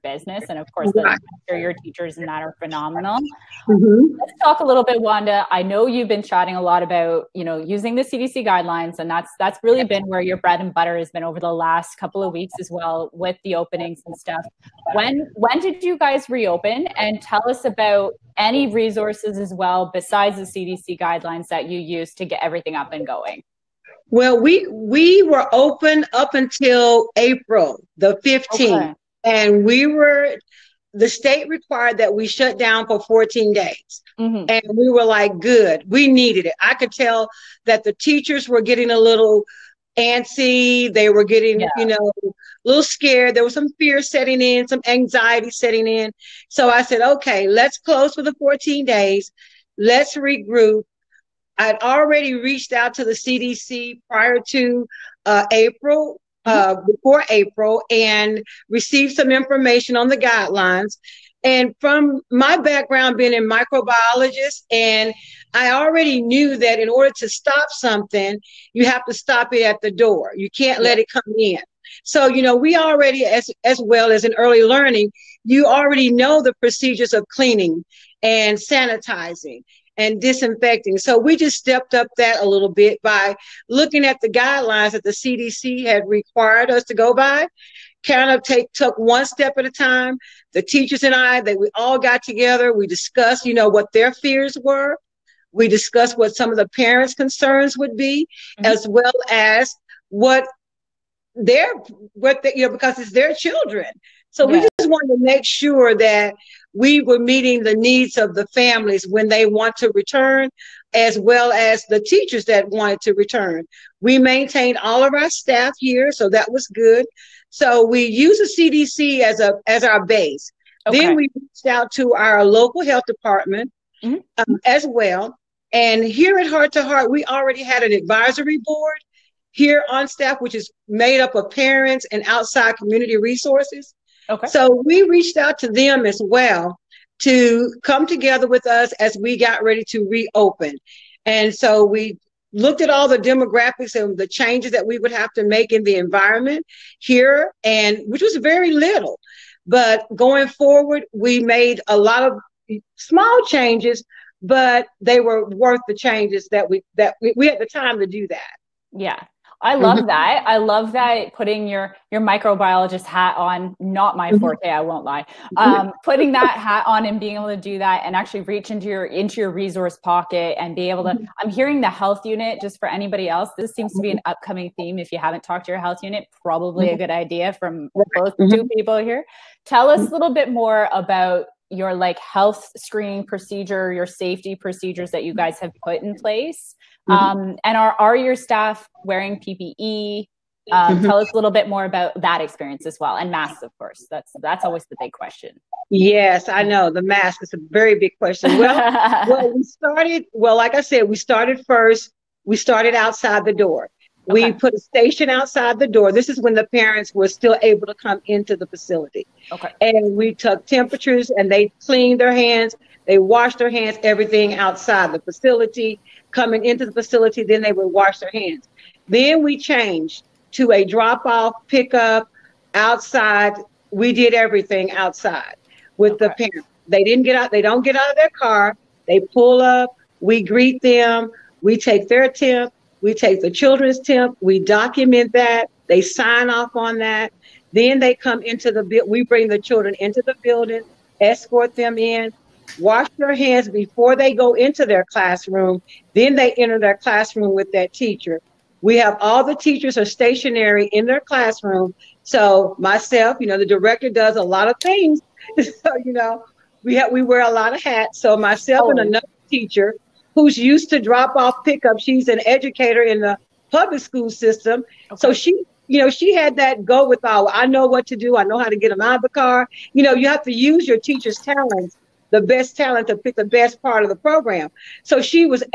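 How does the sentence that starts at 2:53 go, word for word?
This seems to be an upcoming theme.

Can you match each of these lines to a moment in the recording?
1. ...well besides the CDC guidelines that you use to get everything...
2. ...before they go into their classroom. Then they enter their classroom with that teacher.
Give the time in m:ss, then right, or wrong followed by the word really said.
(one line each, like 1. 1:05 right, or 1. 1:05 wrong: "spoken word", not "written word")
1. 0:19 right
2. 4:03 right.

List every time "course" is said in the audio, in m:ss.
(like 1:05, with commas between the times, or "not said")
0:00, 3:13.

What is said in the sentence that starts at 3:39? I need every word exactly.
Then we changed to a drop off, pickup outside.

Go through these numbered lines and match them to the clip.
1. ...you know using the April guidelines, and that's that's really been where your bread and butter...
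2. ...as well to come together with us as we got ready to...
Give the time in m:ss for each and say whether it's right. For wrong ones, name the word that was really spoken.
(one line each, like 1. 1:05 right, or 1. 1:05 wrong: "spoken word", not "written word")
1. 0:07 wrong: "CDC", not "April"
2. 2:16 right.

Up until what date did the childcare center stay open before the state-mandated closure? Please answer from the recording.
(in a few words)
April 15.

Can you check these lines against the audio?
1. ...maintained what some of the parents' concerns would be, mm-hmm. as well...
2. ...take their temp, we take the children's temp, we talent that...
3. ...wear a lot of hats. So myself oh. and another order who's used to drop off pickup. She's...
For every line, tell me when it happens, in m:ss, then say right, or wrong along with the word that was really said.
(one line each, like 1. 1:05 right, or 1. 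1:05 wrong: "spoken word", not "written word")
1. 1:35 wrong: "discussed", not "maintained"
2. 3:51 wrong: "document", not "talent"
3. 4:17 wrong: "teacher", not "order".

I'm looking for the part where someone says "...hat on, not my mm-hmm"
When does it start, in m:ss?
2:43.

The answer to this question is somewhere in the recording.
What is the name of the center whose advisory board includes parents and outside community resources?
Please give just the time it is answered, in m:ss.
2:06.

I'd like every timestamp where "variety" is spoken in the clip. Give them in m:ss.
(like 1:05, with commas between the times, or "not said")
not said.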